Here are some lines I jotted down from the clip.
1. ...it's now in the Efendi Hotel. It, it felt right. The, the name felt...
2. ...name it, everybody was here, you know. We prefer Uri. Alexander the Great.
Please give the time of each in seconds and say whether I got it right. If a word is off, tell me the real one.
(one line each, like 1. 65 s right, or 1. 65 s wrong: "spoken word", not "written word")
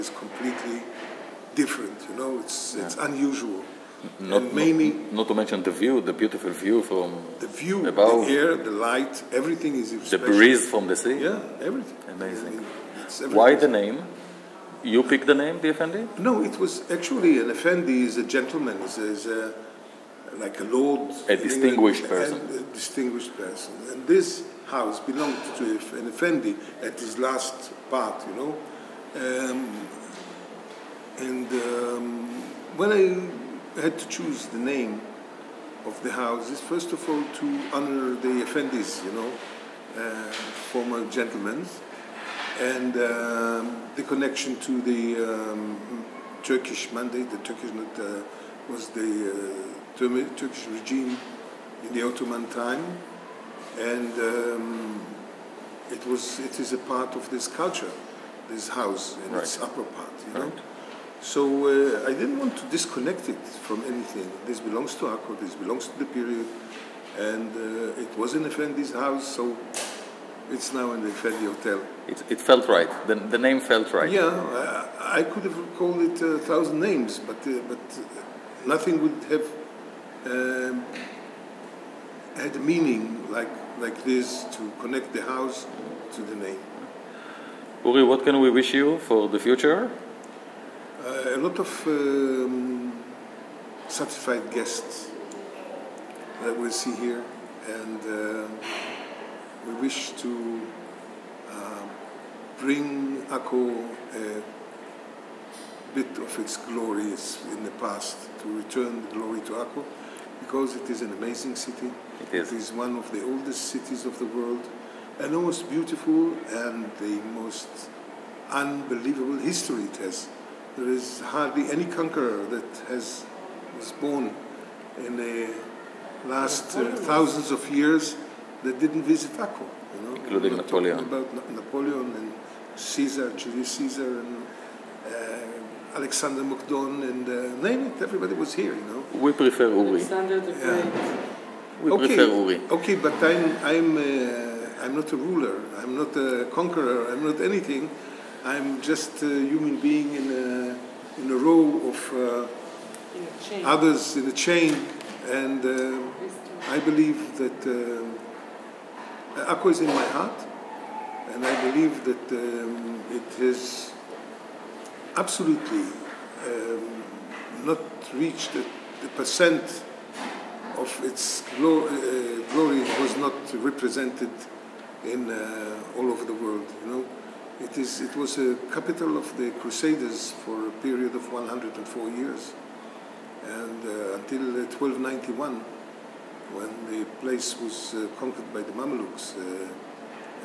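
1. 70 s right
2. 137 s right.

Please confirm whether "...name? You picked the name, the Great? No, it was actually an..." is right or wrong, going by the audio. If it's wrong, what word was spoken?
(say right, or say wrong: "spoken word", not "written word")
wrong: "Efendi", not "Great".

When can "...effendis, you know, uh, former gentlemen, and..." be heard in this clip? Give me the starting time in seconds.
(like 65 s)
38 s.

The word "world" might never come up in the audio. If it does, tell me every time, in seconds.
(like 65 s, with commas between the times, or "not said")
114 s, 176 s.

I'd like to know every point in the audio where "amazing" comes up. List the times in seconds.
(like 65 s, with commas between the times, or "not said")
12 s, 111 s.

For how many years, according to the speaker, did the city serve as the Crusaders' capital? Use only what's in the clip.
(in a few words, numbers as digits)
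104.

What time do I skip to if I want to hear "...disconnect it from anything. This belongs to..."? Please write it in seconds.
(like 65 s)
62 s.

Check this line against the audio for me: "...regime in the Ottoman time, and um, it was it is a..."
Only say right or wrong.
right.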